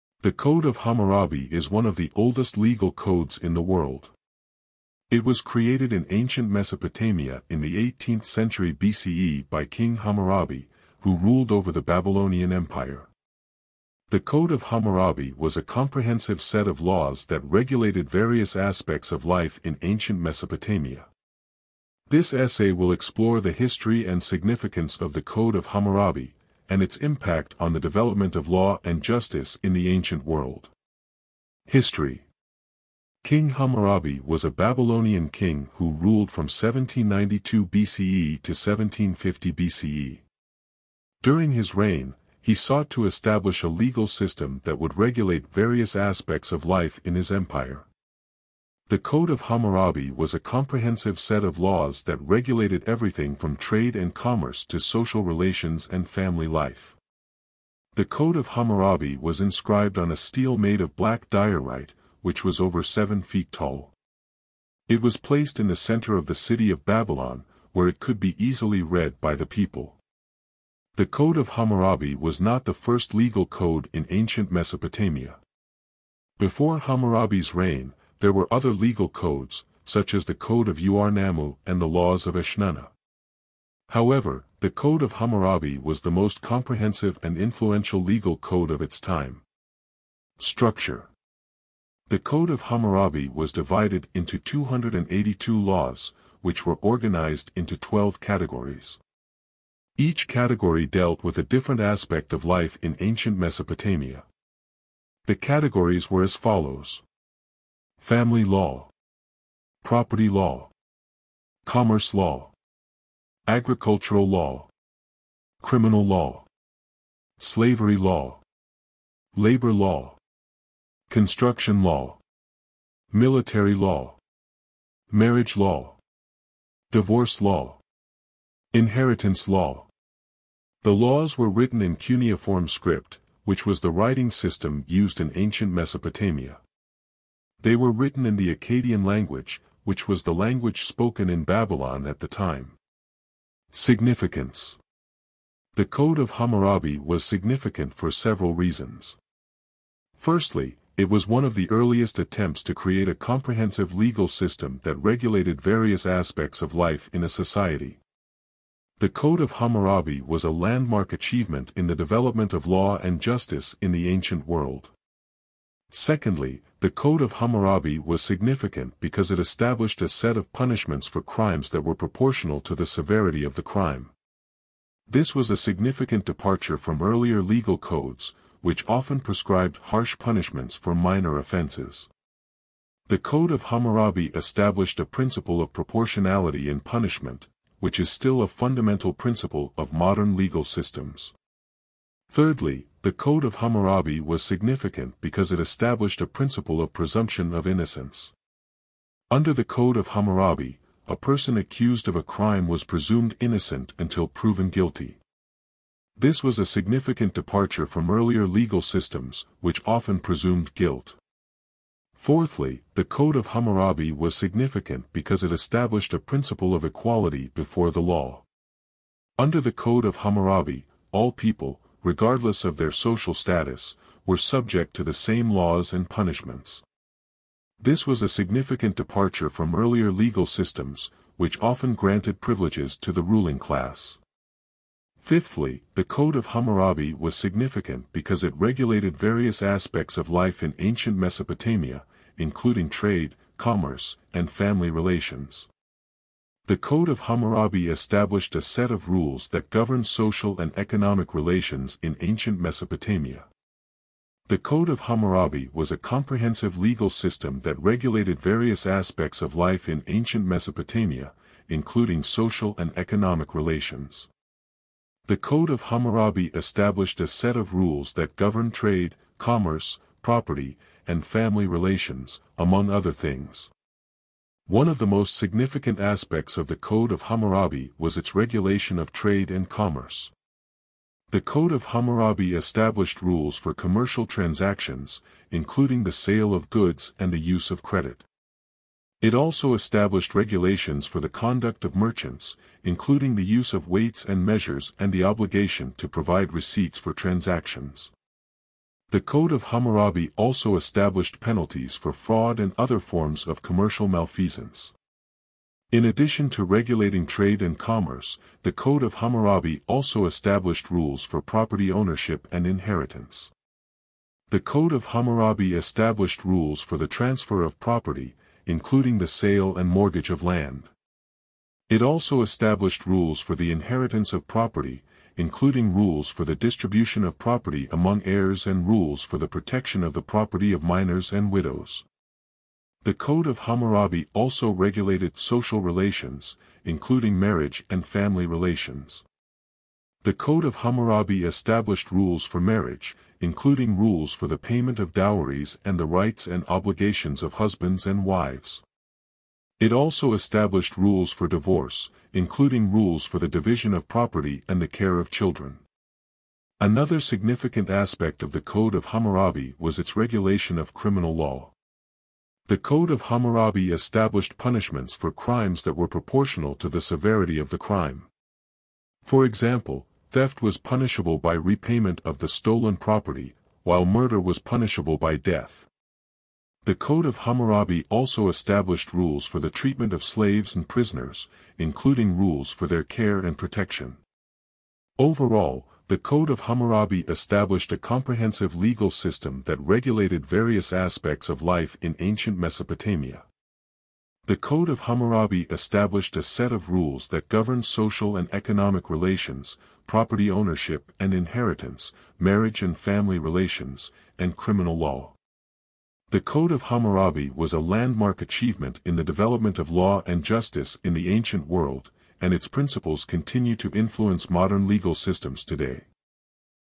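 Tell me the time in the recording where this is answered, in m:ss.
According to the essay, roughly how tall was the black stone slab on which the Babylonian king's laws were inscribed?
1:02.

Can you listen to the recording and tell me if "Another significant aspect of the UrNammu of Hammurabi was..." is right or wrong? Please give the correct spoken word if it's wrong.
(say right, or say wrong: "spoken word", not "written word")
wrong: "Code", not "UrNammu".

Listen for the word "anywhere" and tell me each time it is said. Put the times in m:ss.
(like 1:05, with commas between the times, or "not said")
not said.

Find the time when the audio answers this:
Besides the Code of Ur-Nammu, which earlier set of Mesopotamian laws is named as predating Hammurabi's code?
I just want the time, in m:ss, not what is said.
1:21.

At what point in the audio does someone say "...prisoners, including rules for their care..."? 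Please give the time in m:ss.
6:20.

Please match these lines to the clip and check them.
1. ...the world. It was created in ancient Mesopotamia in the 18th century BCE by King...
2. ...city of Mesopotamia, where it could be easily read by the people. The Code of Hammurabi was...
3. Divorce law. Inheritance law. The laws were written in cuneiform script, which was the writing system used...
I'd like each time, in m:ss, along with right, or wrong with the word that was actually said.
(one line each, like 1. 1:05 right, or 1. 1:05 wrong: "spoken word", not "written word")
1. 0:03 right
2. 1:06 wrong: "Babylon", not "Mesopotamia"
3. 2:06 right.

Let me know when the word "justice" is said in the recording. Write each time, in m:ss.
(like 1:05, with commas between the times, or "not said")
0:29, 2:43, 6:50.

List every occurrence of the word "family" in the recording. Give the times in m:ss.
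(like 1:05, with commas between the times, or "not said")
0:56, 1:48, 4:04, 4:31, 5:38, 6:42.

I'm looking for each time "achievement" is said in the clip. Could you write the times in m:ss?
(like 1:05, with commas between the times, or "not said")
2:41, 6:48.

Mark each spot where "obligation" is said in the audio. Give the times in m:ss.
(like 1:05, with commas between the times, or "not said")
4:55, 5:46.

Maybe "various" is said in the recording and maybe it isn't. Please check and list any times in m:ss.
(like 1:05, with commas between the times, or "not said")
0:18, 0:45, 2:35, 3:59, 4:18, 6:30.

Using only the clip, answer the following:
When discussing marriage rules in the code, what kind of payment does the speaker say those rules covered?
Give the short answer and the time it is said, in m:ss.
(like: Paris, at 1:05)
Dowries, at 5:45.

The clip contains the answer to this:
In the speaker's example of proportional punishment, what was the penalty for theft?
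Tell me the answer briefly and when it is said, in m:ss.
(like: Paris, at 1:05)
Repayment of the stolen property, at 6:11.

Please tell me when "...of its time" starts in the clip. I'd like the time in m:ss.
1:28.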